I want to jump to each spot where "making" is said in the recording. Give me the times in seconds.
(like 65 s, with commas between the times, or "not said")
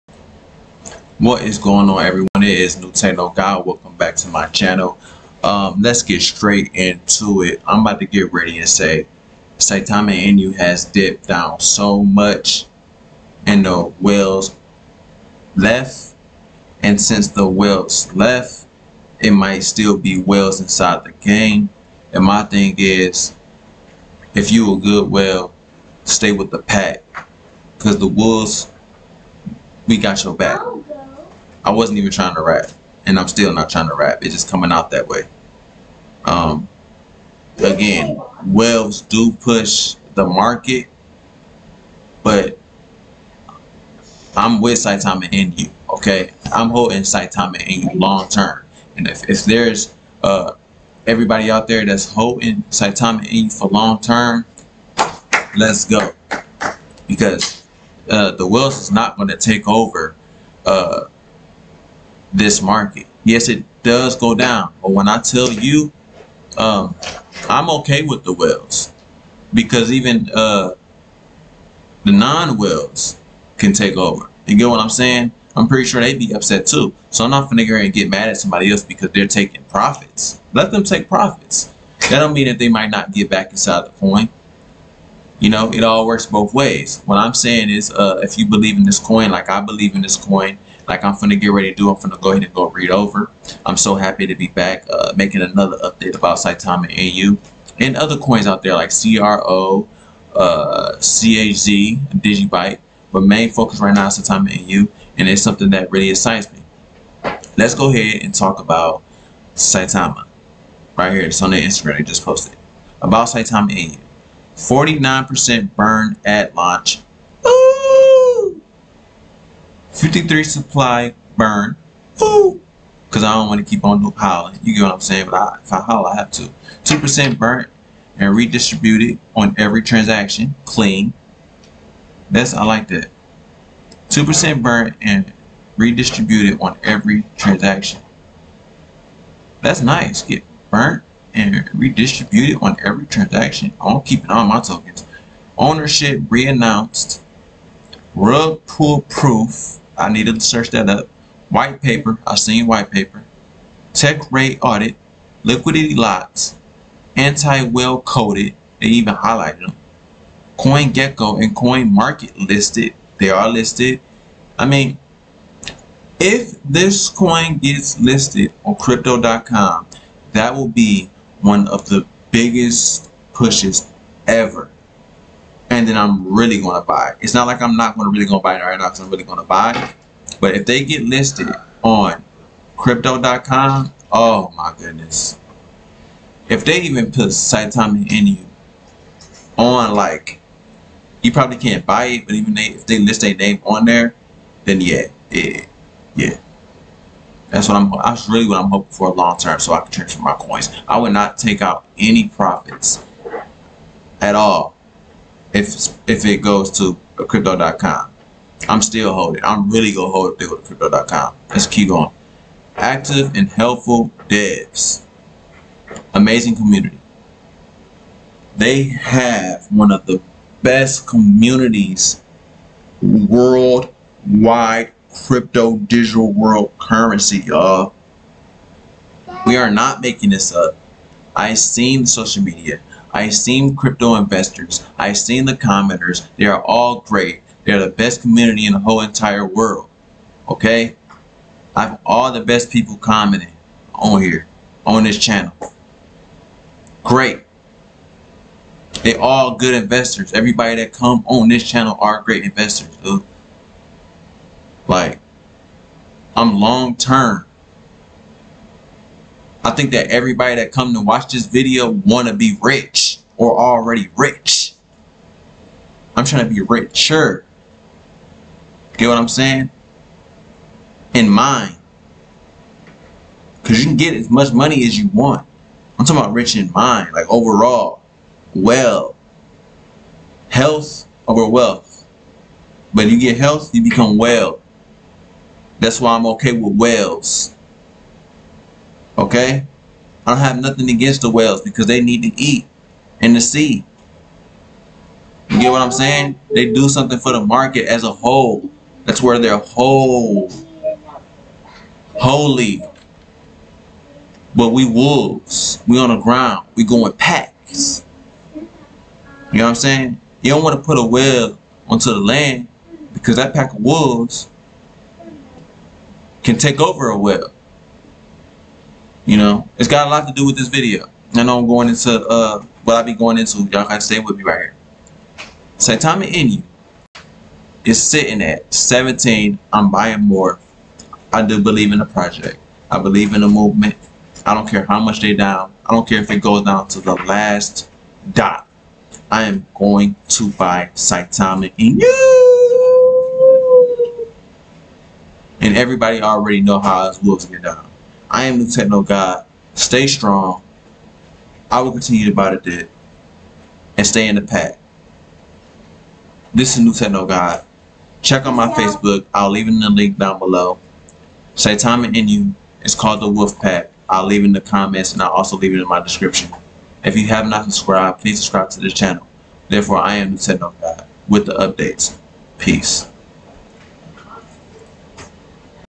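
95 s, 230 s.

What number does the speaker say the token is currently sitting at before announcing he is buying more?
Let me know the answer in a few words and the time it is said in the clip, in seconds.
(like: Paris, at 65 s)
17, at 328 s.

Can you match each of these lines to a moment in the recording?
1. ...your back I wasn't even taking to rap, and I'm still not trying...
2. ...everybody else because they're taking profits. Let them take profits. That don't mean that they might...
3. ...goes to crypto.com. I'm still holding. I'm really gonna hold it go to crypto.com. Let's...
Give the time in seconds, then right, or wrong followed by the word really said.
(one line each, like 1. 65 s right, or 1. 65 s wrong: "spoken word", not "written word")
1. 30 s wrong: "trying", not "taking"
2. 78 s wrong: "somebody", not "everybody"
3. 206 s right.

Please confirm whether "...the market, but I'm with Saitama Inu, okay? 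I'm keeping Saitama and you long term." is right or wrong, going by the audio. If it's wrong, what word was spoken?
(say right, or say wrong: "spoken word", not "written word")
wrong: "holding", not "keeping".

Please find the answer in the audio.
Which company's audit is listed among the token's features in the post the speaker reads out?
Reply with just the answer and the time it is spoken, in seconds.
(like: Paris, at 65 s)
TechRate, at 153 s.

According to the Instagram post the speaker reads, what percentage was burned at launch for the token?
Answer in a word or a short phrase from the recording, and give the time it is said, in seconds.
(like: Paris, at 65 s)
49%, at 114 s.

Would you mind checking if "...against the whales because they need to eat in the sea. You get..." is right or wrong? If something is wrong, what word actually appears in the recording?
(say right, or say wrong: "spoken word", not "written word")
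right.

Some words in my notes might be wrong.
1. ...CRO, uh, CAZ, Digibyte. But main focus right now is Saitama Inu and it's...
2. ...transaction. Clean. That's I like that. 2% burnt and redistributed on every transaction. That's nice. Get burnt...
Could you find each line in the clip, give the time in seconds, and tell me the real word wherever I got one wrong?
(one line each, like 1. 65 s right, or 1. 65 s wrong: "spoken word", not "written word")
1. 98 s right
2. 129 s right.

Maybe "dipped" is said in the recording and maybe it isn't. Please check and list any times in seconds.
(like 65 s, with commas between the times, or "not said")
10 s.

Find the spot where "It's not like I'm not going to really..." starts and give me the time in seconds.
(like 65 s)
177 s.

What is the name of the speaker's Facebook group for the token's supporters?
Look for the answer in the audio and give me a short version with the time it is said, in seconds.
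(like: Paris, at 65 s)
the Wolf Pack, at 363 s.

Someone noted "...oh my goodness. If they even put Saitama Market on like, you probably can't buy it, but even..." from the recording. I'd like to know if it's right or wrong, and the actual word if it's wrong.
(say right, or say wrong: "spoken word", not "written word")
wrong: "Inu", not "Market".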